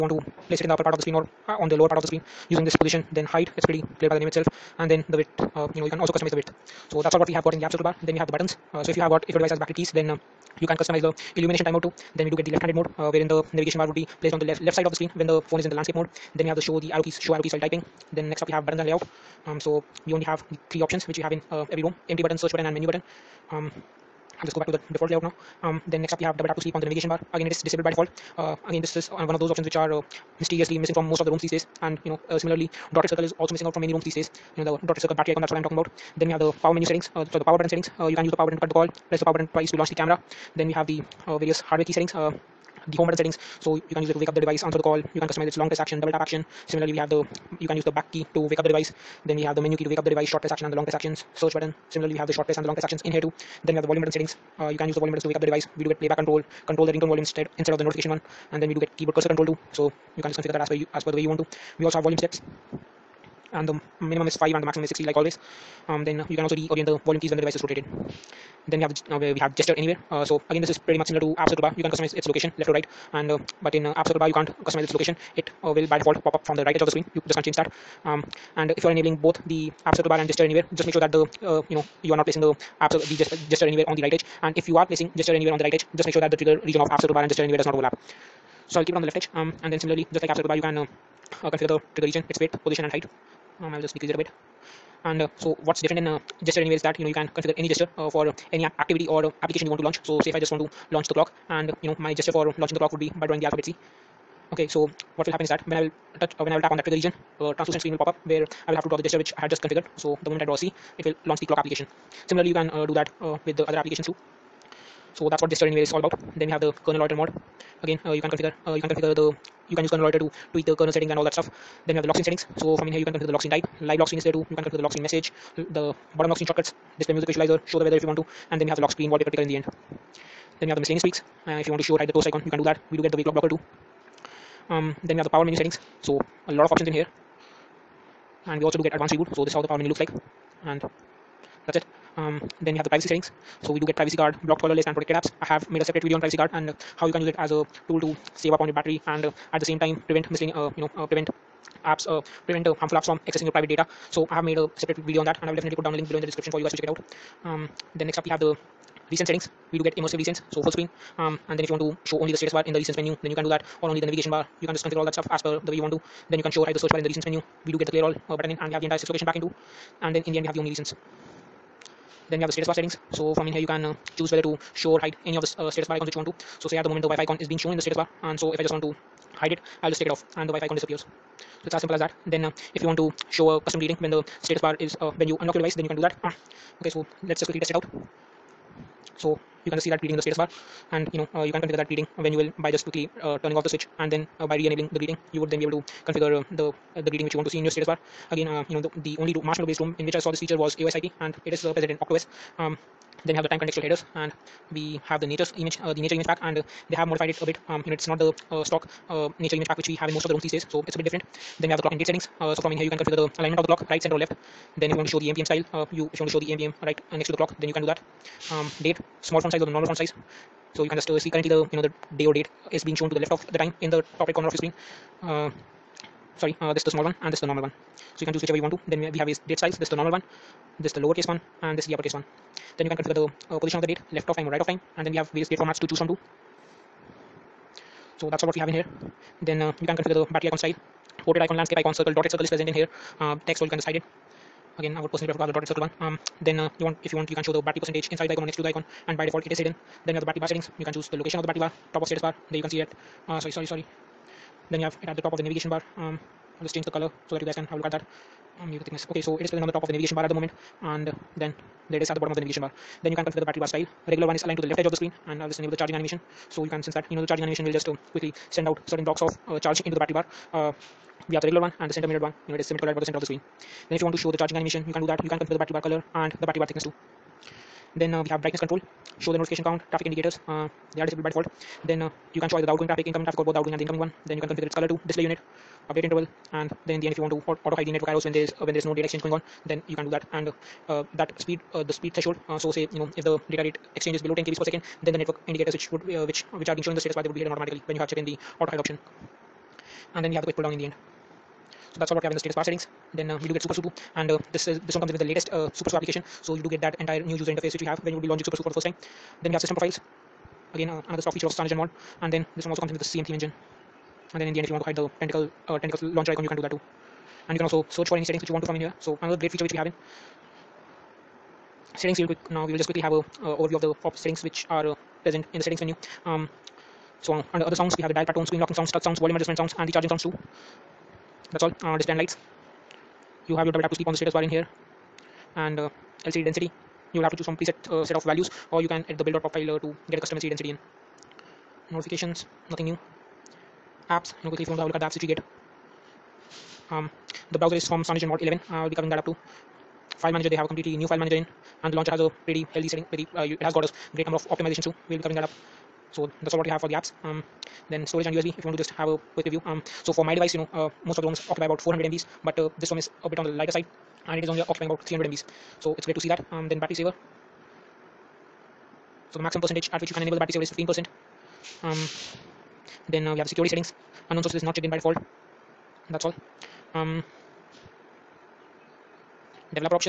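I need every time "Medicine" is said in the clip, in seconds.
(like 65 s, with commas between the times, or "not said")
not said.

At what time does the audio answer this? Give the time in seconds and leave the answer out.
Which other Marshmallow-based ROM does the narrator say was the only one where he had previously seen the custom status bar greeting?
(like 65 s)
200 s.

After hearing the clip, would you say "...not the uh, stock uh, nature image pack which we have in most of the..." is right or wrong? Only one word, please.
right.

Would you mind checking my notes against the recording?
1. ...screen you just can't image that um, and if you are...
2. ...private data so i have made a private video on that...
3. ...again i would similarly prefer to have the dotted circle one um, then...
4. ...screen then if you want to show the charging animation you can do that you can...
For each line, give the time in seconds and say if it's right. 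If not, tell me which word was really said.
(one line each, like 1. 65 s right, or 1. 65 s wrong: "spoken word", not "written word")
1. 76 s wrong: "change", not "image"
2. 153 s wrong: "separate", not "private"
3. 244 s wrong: "personally", not "similarly"
4. 273 s right.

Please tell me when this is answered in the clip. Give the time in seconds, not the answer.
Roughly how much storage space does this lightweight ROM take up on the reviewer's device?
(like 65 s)
365 s.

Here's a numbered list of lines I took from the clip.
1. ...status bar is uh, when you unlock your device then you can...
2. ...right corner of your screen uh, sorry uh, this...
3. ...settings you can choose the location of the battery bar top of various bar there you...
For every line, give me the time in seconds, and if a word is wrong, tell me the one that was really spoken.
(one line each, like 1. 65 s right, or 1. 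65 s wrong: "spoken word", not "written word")
1. 184 s right
2. 224 s right
3. 250 s wrong: "status", not "various".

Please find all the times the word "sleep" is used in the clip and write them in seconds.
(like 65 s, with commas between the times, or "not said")
26 s, 333 s.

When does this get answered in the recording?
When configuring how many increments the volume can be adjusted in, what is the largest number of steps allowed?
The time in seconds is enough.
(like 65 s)
64 s.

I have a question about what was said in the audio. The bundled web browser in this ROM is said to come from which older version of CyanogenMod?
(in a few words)
CyanogenMod 11.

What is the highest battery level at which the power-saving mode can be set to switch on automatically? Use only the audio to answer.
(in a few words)
15%.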